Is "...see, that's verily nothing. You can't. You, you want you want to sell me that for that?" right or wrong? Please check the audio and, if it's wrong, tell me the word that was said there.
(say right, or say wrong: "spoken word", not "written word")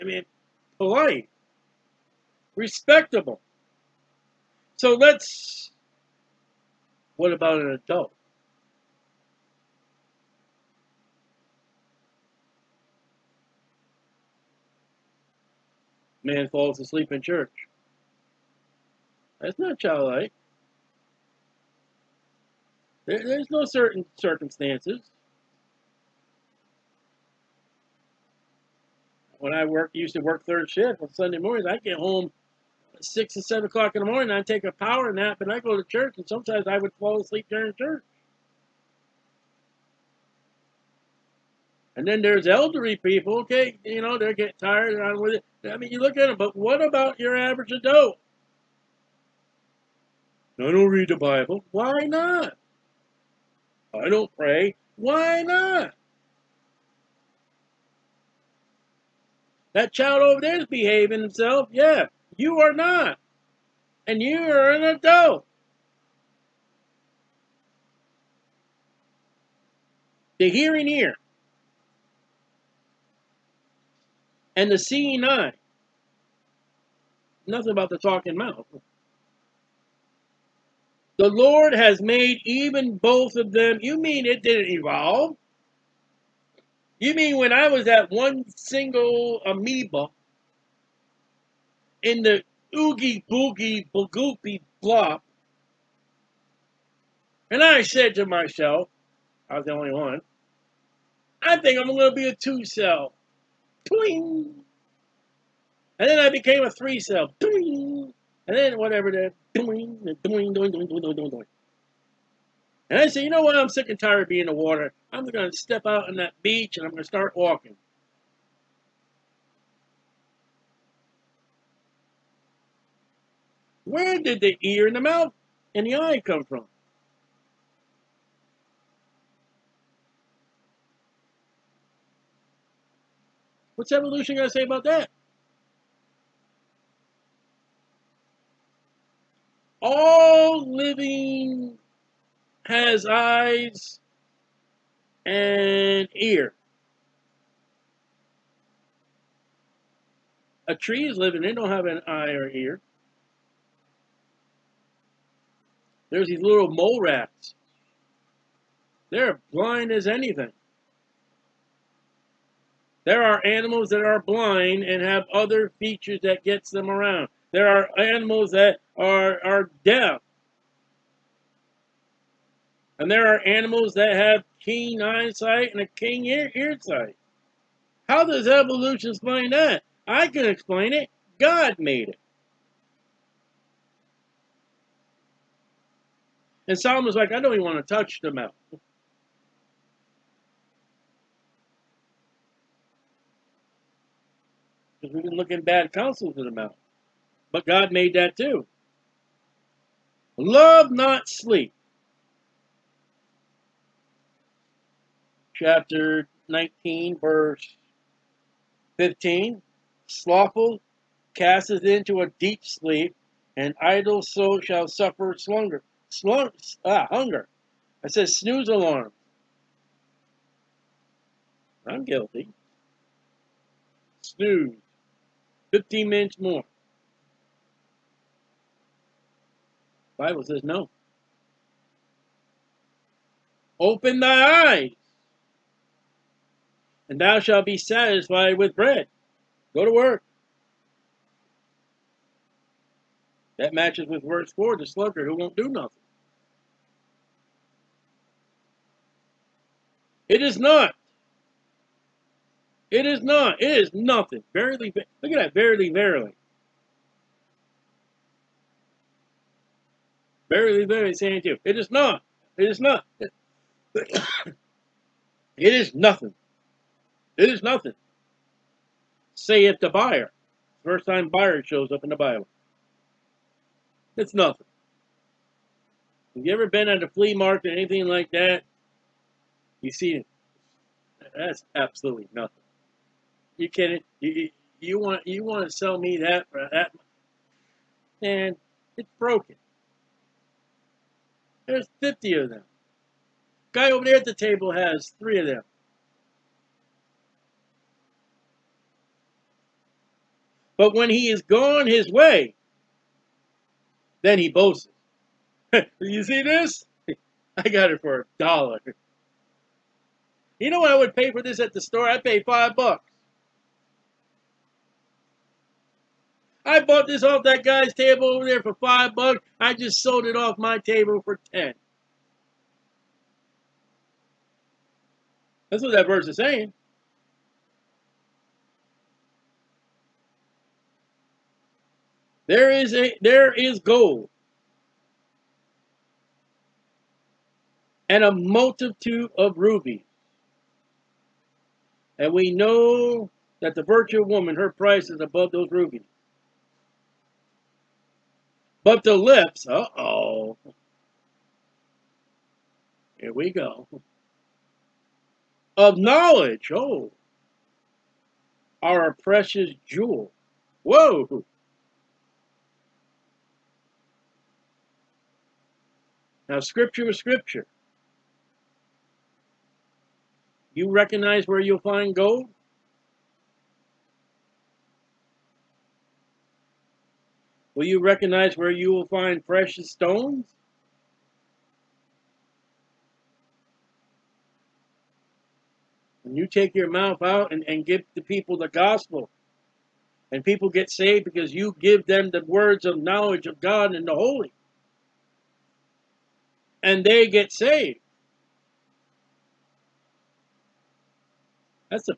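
wrong: "absolutely", not "verily".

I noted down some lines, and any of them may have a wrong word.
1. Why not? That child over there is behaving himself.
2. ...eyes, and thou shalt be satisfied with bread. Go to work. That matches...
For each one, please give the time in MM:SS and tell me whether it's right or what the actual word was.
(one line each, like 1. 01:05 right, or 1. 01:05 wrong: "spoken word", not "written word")
1. 00:54 right
2. 03:54 right.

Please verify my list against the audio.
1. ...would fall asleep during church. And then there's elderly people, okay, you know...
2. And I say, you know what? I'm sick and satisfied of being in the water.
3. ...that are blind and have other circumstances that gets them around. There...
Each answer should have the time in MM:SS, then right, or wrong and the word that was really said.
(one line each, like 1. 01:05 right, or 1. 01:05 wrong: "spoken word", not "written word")
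1. 00:36 right
2. 01:52 wrong: "tired", not "satisfied"
3. 02:43 wrong: "features", not "circumstances".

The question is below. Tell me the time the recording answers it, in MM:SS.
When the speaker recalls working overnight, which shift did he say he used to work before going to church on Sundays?
00:30.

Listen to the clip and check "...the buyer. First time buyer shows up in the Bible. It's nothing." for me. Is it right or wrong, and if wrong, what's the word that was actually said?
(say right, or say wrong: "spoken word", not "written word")
right.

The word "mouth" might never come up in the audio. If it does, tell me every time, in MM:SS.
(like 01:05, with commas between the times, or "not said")
01:18, 02:04, 03:08, 03:16, 06:26.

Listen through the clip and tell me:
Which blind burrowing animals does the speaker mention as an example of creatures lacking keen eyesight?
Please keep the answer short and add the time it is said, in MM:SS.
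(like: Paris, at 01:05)
mole rats, at 02:36.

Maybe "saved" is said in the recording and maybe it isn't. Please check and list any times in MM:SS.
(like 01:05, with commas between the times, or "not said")
06:30, 06:37.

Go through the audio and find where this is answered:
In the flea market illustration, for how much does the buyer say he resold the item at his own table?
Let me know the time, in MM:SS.
05:21.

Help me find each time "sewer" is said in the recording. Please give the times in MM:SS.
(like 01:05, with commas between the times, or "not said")
not said.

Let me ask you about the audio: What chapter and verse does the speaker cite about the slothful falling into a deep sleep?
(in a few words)
Chapter 19, verse 15.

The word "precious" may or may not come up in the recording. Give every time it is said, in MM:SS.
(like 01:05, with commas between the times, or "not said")
05:59, 06:19.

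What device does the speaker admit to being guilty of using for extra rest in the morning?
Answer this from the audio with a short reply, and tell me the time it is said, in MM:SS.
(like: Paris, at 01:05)
snooze alarm, at 03:38.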